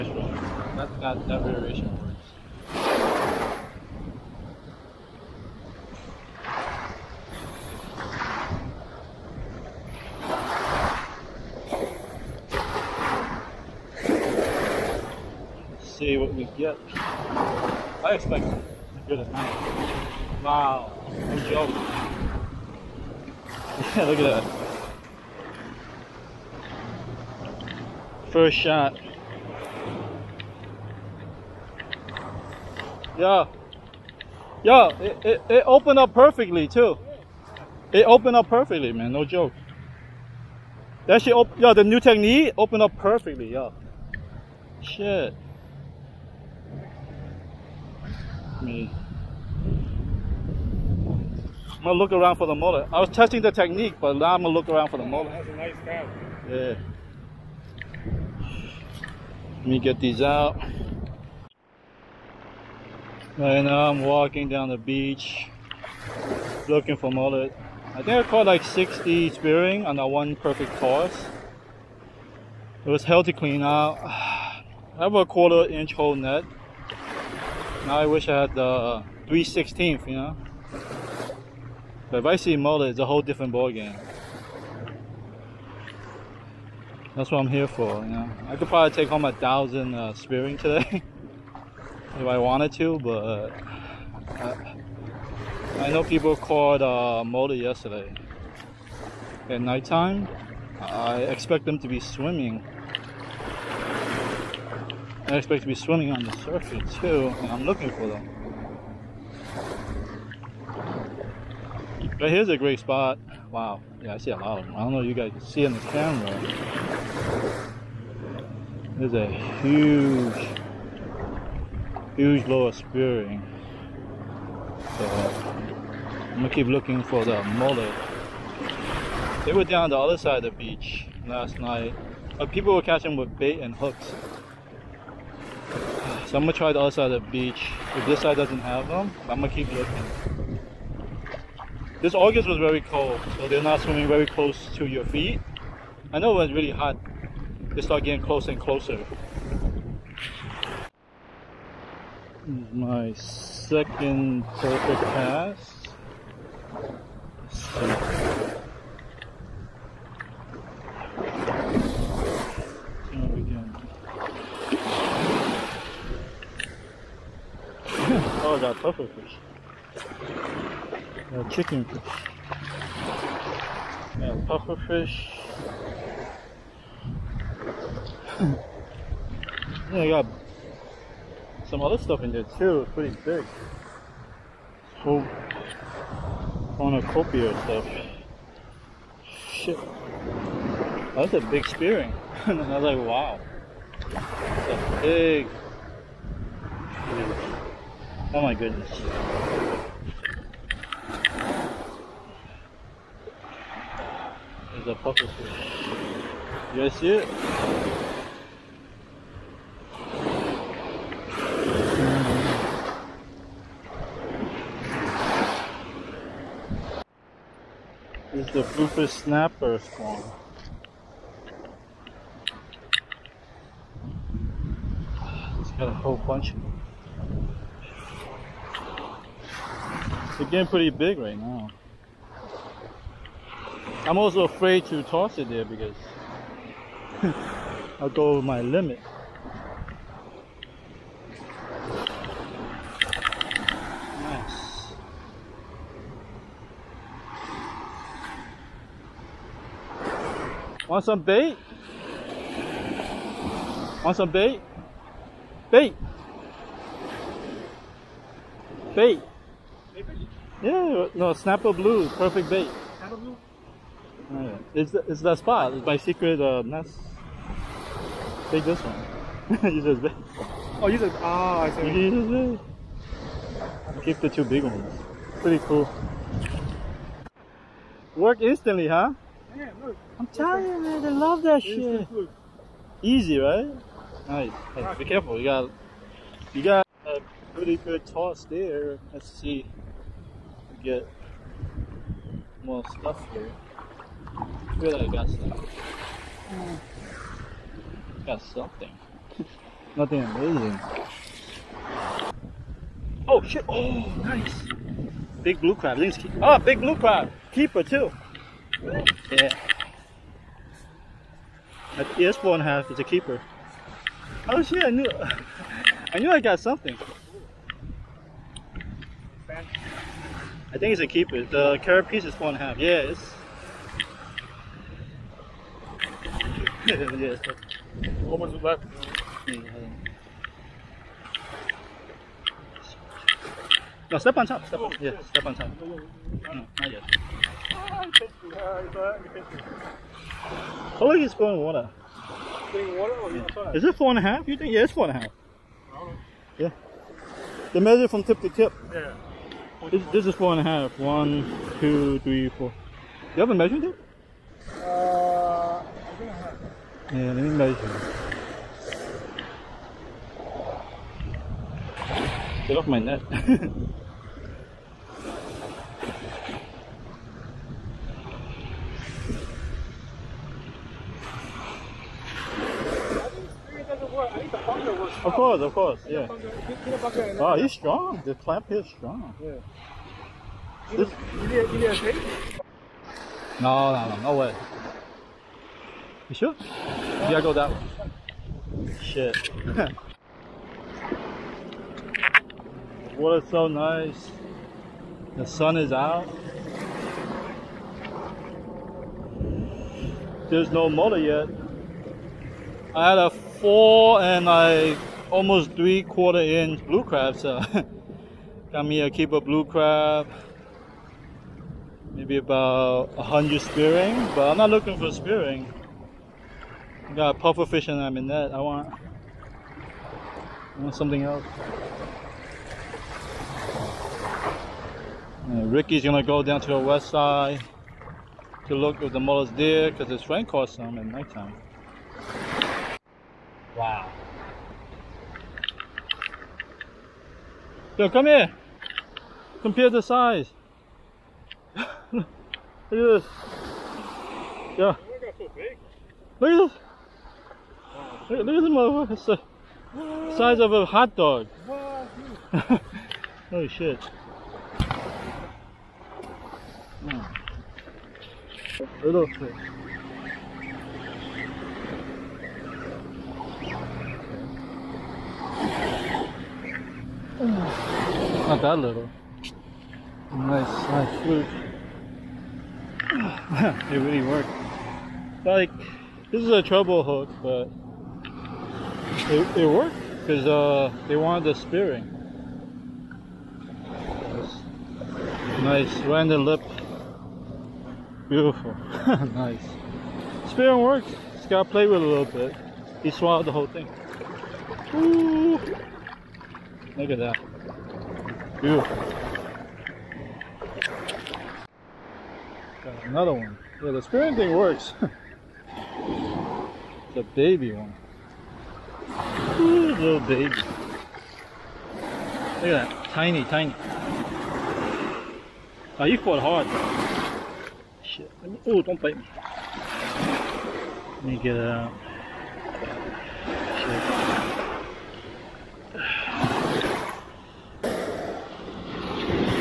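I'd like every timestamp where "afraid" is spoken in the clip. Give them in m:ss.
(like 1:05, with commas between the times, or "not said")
3:54.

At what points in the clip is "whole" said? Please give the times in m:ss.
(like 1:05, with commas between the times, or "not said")
1:23, 3:04, 3:45, 8:13.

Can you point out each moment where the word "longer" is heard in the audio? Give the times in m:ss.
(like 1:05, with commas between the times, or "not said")
not said.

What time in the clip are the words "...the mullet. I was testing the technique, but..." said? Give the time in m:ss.
0:52.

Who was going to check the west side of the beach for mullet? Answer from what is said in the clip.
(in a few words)
Ricky.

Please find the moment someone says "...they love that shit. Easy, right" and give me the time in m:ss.
4:41.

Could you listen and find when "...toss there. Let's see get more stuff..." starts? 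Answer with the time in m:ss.
4:48.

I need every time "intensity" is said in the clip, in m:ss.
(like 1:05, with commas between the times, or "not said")
not said.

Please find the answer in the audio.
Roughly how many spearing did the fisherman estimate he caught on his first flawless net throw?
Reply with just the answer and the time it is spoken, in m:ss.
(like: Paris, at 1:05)
60, at 1:08.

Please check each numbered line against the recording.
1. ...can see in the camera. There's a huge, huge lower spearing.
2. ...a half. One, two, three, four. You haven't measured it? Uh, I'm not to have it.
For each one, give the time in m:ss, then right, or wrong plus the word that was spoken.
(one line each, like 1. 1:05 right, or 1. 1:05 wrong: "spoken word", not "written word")
1. 1:55 right
2. 5:50 right.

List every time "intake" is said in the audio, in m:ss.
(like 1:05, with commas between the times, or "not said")
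not said.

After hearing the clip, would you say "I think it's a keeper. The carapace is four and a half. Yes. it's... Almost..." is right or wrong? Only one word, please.
right.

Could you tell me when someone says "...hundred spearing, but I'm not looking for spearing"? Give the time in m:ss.
6:53.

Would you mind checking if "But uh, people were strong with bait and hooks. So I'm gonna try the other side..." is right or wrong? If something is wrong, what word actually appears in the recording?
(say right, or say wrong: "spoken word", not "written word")
wrong: "catching", not "strong".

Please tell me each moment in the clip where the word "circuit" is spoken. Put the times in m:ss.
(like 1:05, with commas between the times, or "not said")
1:46.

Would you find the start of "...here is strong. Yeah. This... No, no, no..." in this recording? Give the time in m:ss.
6:18.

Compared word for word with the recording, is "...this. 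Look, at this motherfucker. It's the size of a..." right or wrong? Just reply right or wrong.
right.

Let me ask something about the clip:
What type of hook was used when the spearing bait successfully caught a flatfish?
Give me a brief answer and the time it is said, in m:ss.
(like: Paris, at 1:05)
treble hook, at 7:56.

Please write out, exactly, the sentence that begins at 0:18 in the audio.
I expect as good as Wow, no joke.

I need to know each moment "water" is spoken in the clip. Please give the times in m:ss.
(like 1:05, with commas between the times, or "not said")
5:41, 6:33.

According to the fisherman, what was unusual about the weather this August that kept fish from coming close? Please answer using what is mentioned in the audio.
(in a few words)
very cold.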